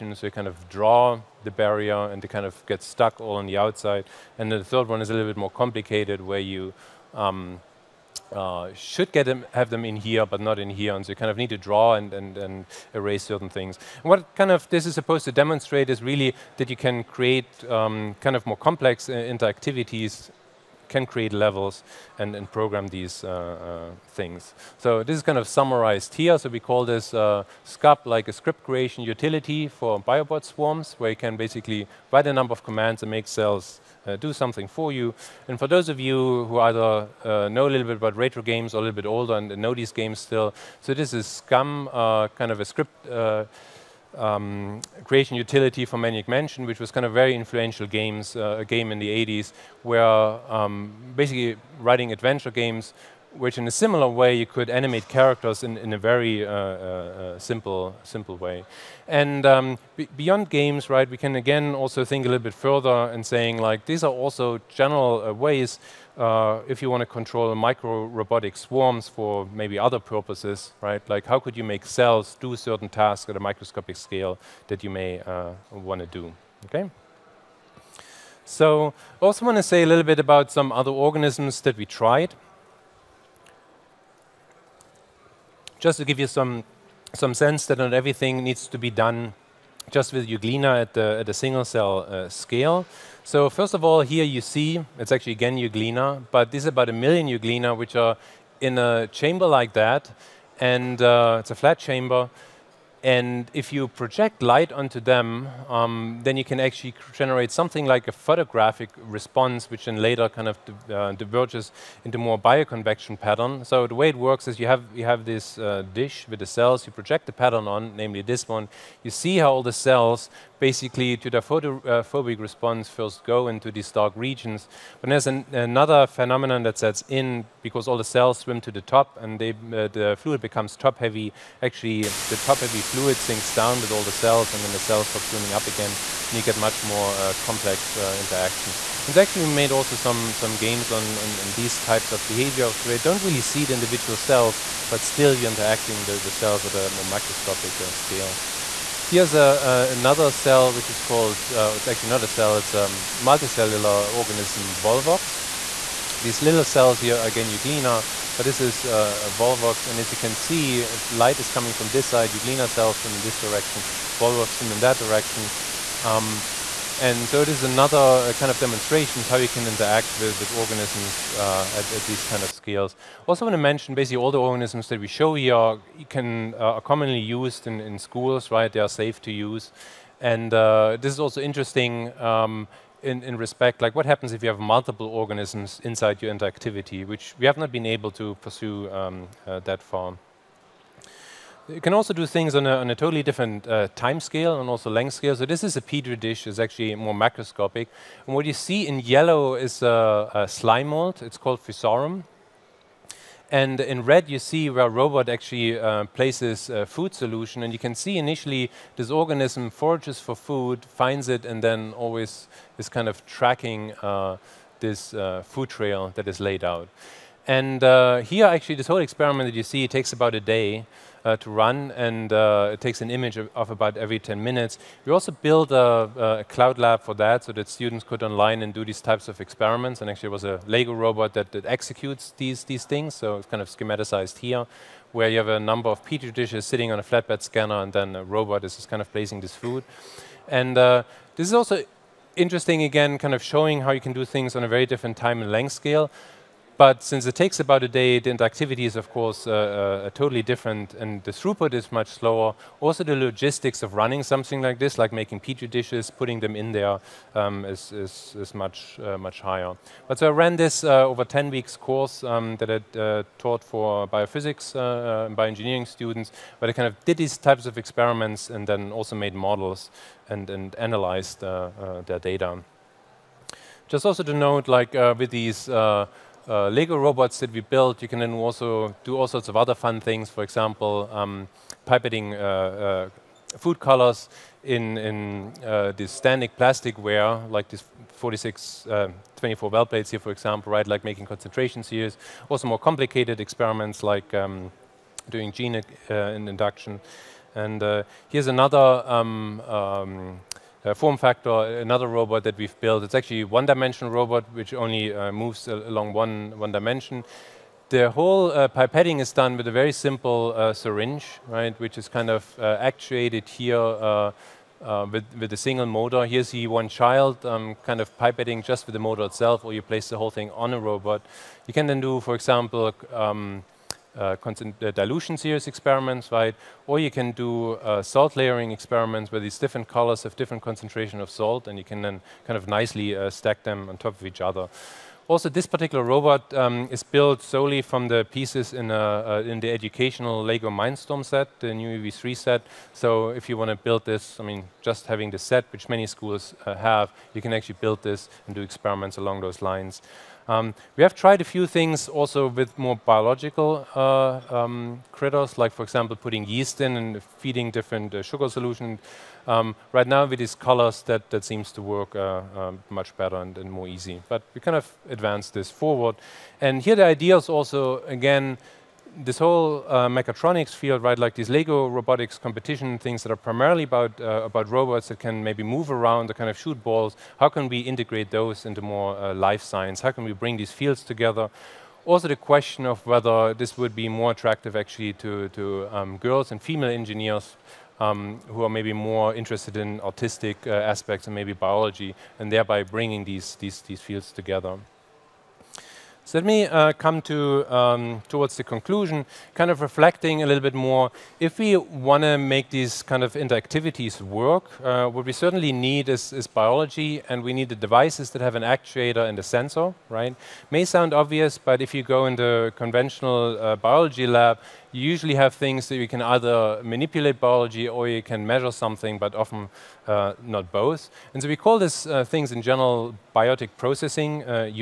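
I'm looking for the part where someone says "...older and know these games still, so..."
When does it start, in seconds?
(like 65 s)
39 s.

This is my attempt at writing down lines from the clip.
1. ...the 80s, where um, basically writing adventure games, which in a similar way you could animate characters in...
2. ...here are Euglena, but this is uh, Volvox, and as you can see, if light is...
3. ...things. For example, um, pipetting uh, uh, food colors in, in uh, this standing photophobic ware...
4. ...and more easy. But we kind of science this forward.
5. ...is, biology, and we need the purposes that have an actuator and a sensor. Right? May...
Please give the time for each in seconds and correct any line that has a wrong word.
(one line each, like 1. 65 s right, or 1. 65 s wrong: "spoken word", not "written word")
1. 48 s right
2. 157 s right
3. 280 s wrong: "plastic", not "photophobic"
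4. 363 s wrong: "advance", not "science"
5. 406 s wrong: "devices", not "purposes".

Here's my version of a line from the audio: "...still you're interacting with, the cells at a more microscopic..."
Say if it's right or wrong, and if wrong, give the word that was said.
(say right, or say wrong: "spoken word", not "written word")
right.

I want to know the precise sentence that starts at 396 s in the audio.
So let me uh, come to um, towards the conclusion, kind of reflecting a little bit more.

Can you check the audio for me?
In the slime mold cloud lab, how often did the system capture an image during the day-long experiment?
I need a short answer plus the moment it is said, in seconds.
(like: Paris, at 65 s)
every 10 minutes, at 223 s.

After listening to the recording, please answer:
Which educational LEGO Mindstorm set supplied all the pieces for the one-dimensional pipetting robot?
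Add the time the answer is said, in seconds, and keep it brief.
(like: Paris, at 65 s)
EV3, at 341 s.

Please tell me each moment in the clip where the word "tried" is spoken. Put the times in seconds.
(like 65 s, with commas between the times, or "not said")
81 s, 351 s.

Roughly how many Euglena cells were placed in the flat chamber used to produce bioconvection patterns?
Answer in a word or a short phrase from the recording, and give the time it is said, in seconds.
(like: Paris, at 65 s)
a million, at 96 s.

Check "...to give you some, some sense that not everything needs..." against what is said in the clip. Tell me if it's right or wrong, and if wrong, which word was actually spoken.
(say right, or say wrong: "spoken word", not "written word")
right.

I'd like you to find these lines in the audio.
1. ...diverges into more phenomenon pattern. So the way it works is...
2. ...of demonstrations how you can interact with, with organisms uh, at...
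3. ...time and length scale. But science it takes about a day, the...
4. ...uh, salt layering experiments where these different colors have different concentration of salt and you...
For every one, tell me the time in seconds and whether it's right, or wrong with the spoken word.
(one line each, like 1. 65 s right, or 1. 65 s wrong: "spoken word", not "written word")
1. 111 s wrong: "bioconvection", not "phenomenon"
2. 168 s right
3. 245 s wrong: "since", not "science"
4. 327 s right.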